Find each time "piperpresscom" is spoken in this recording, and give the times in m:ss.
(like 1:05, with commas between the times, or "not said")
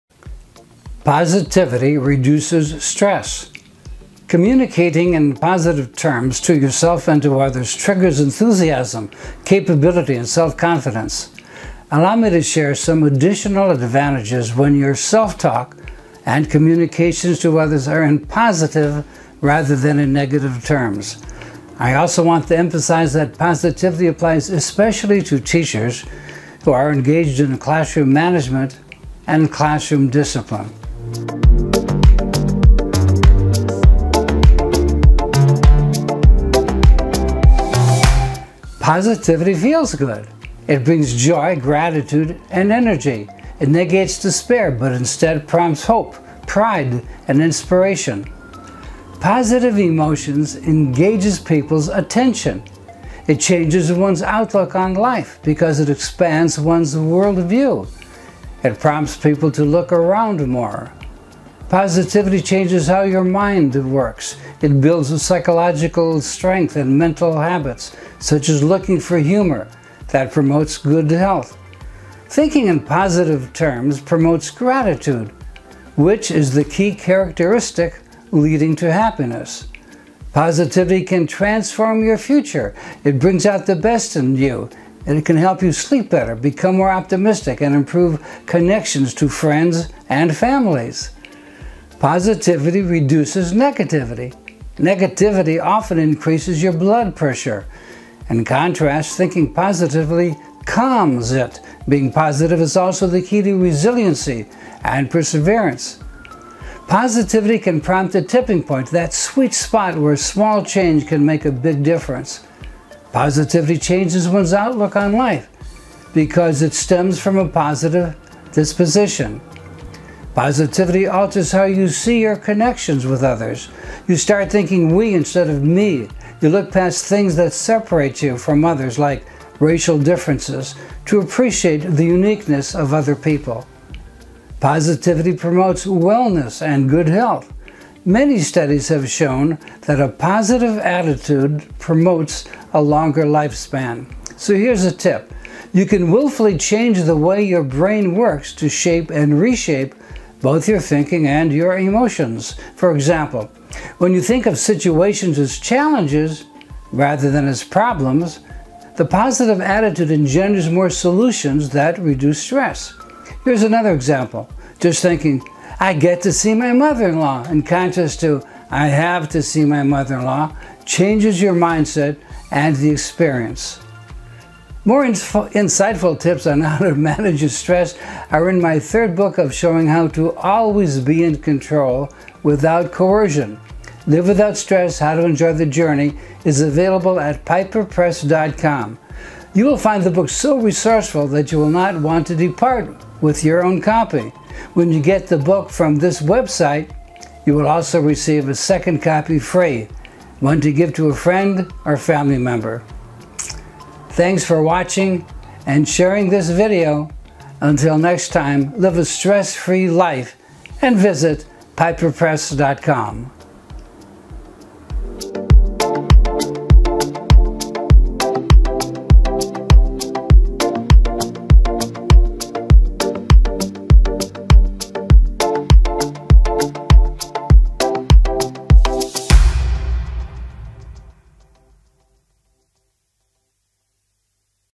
3:07, 3:31.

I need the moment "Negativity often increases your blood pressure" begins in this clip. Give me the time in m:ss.
1:34.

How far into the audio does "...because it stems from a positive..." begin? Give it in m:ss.
1:56.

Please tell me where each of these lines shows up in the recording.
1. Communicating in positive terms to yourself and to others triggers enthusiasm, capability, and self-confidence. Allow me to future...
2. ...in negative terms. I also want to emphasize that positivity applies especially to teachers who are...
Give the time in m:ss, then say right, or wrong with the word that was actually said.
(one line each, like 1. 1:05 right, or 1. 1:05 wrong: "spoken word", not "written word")
1. 0:04 wrong: "share", not "future"
2. 0:19 right.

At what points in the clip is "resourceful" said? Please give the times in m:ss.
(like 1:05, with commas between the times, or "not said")
3:10.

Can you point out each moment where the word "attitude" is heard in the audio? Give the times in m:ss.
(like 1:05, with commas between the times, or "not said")
2:20, 2:39.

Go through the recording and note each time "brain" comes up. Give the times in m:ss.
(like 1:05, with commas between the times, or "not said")
2:27.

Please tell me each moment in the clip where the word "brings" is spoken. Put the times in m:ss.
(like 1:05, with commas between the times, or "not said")
0:40, 1:23.